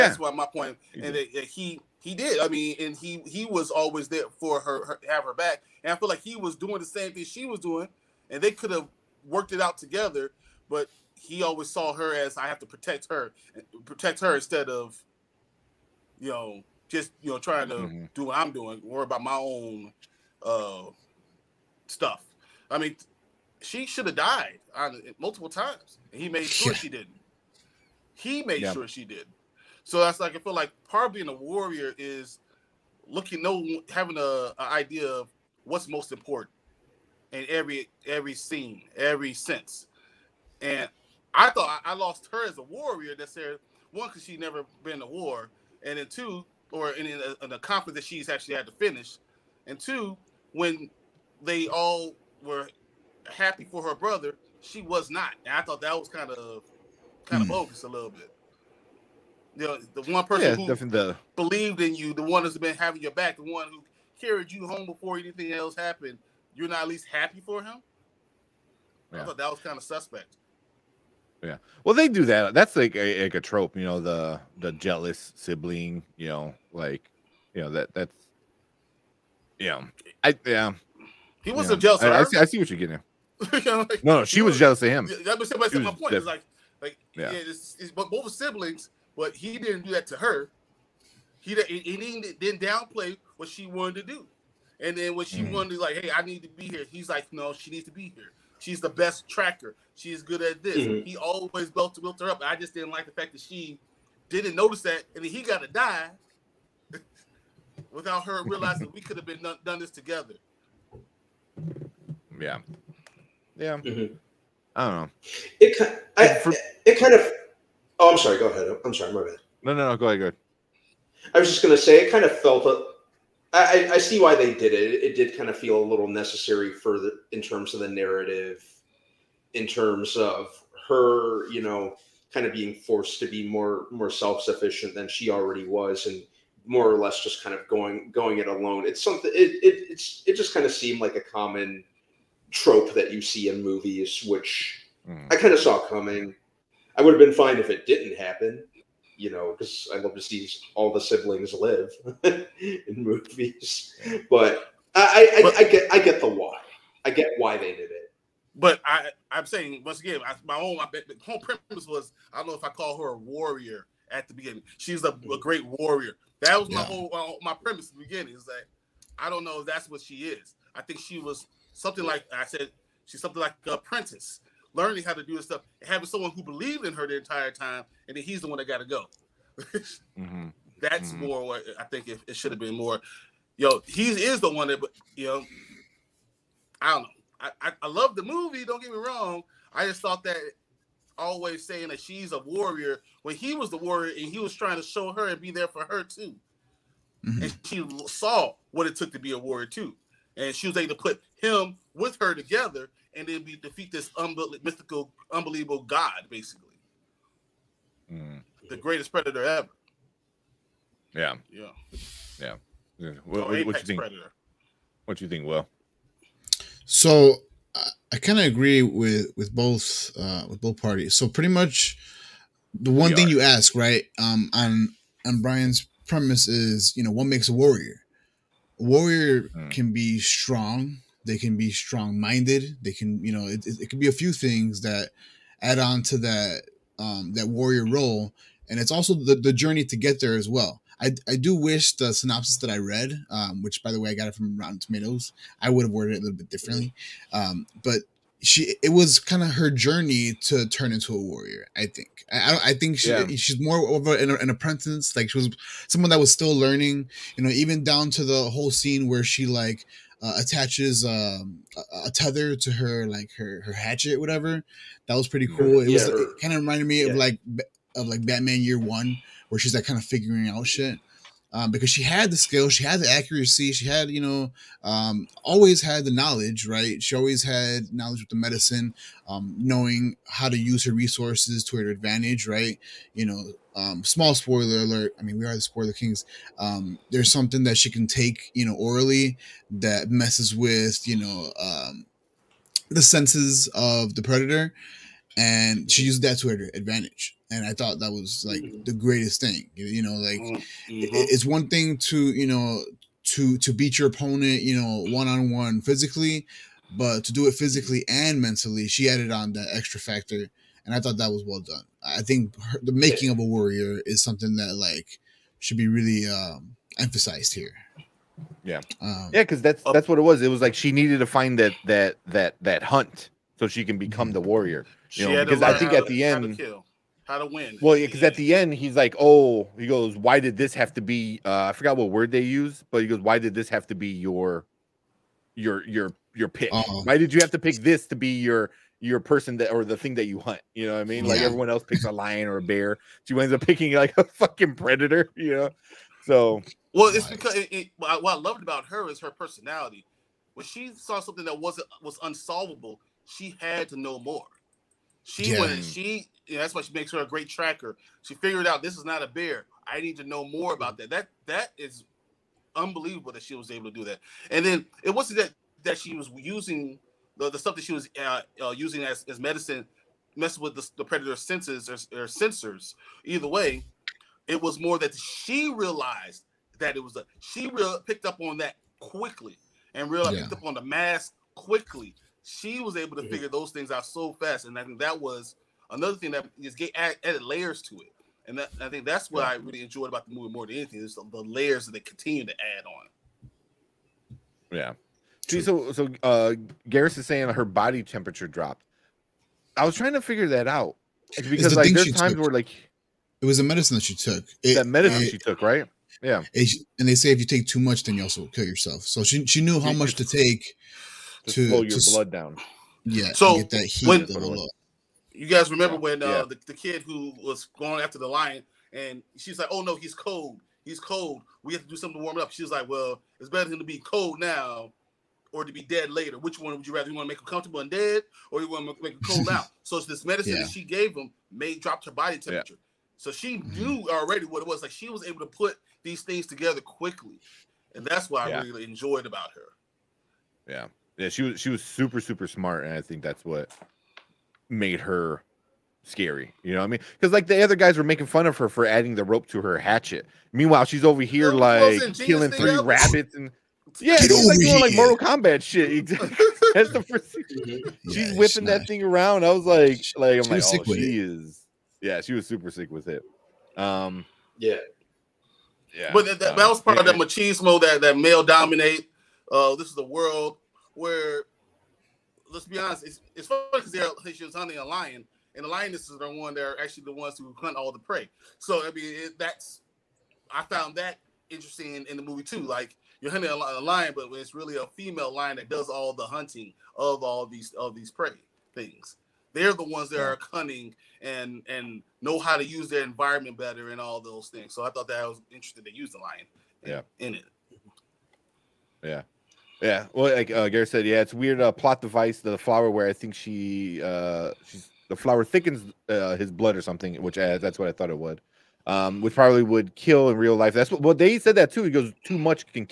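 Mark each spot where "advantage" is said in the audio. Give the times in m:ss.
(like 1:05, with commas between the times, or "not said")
4:41, 4:56.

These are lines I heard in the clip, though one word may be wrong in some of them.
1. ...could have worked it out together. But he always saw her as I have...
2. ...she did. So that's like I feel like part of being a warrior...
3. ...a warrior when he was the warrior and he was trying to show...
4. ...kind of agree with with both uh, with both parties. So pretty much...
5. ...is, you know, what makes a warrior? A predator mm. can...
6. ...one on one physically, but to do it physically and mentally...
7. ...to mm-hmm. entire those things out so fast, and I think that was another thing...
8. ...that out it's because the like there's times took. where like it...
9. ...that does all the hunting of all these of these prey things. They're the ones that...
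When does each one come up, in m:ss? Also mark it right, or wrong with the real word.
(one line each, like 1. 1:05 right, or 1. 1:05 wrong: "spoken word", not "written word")
1. 0:08 right
2. 0:28 right
3. 3:12 right
4. 3:38 right
5. 3:46 wrong: "warrior", not "predator"
6. 5:05 right
7. 6:23 wrong: "figure", not "entire"
8. 6:40 right
9. 8:05 right.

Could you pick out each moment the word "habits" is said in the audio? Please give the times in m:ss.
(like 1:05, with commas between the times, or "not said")
not said.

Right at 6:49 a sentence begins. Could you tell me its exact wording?
So she she knew how much to take to, slow your to, blood down.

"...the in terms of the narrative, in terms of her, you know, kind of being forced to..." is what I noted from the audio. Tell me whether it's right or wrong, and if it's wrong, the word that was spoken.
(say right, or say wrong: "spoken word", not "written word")
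right.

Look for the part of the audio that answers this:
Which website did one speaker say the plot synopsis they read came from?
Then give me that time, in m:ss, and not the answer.
4:04.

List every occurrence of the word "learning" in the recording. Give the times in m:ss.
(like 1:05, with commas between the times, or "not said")
2:54, 4:16.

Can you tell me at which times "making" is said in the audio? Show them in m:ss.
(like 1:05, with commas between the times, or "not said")
5:12, 7:28.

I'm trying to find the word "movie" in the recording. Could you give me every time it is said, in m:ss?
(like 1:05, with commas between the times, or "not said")
2:23, 2:32, 3:08, 6:30, 8:02.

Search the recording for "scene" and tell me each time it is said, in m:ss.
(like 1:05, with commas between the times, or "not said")
0:38, 4:18.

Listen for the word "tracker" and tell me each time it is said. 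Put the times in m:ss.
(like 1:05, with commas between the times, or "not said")
1:39, 5:57.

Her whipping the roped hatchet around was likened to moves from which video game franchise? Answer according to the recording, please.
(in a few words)
Mortal Kombat.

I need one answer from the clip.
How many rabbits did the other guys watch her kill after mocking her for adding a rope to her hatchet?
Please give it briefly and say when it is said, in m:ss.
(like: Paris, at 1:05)
3, at 7:32.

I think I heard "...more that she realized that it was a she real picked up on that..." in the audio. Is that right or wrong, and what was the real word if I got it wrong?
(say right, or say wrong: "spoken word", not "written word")
right.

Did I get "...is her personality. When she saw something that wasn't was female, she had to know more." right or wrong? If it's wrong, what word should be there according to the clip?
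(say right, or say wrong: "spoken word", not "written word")
wrong: "unsolvable", not "female".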